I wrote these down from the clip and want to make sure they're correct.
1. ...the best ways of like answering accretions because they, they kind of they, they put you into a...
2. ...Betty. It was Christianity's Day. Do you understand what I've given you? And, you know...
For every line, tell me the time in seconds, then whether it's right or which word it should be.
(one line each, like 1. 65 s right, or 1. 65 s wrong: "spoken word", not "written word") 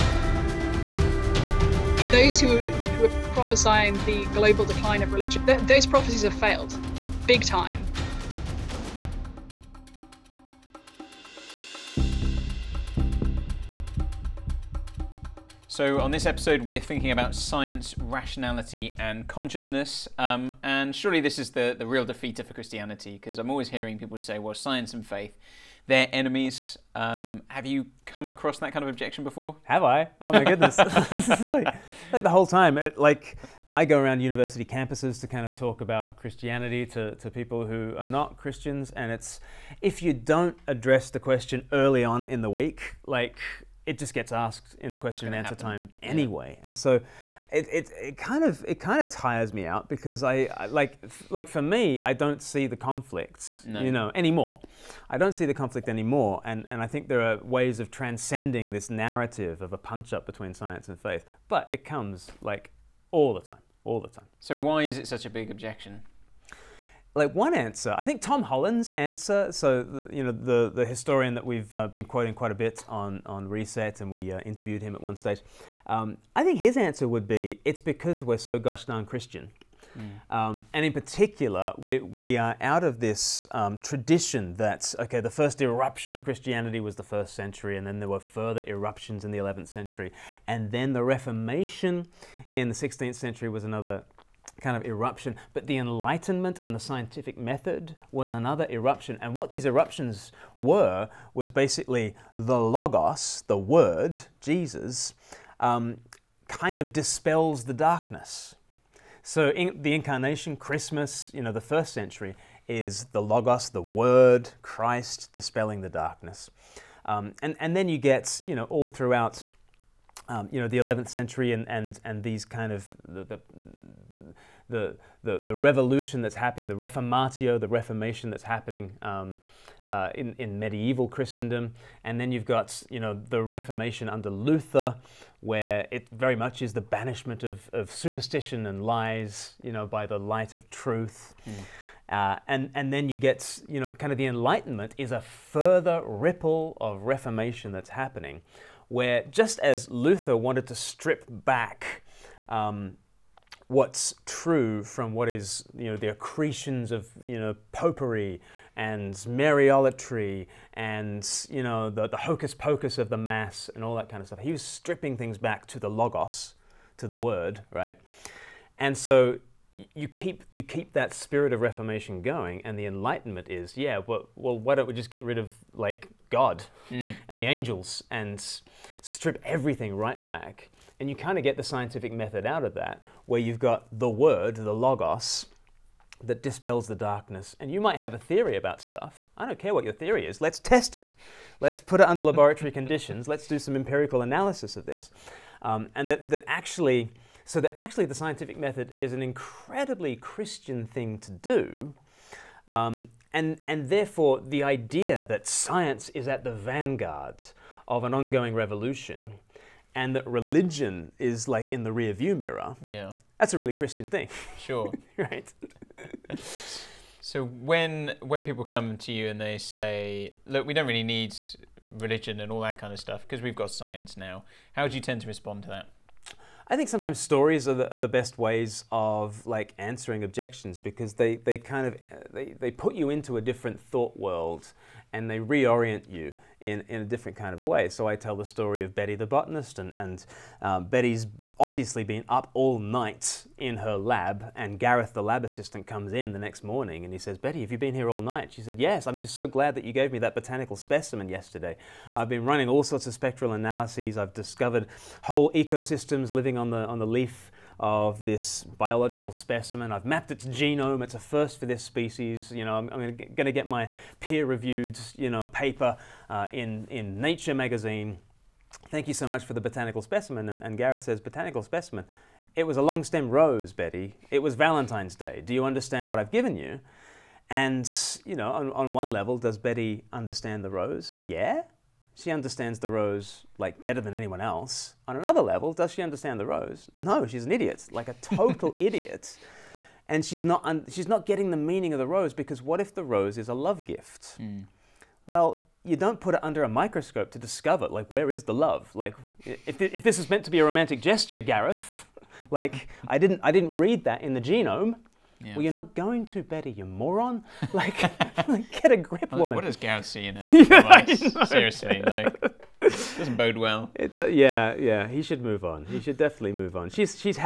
1. 227 s wrong: "objections", not "accretions"
2. 273 s wrong: "Valentine", not "Christianity".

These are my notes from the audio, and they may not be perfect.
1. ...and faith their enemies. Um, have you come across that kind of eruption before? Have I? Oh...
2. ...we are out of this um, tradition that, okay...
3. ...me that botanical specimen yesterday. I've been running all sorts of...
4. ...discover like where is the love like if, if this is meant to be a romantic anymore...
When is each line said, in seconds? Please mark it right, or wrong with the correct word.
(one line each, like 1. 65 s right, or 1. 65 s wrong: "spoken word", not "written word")
1. 24 s wrong: "objection", not "eruption"
2. 81 s right
3. 250 s right
4. 297 s wrong: "gesture", not "anymore".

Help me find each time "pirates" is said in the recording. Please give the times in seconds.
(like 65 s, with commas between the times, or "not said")
not said.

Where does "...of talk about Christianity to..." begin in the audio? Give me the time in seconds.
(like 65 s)
35 s.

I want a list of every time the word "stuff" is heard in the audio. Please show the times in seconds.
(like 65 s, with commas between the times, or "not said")
164 s, 188 s, 222 s.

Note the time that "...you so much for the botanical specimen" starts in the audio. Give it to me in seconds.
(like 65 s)
269 s.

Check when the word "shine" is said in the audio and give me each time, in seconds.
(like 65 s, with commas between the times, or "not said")
not said.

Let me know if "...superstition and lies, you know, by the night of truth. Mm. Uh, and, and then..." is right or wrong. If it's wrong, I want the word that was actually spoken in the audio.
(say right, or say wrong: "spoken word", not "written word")
wrong: "light", not "night".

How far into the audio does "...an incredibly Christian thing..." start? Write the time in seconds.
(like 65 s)
199 s.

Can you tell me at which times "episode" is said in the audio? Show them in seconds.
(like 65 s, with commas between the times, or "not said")
16 s.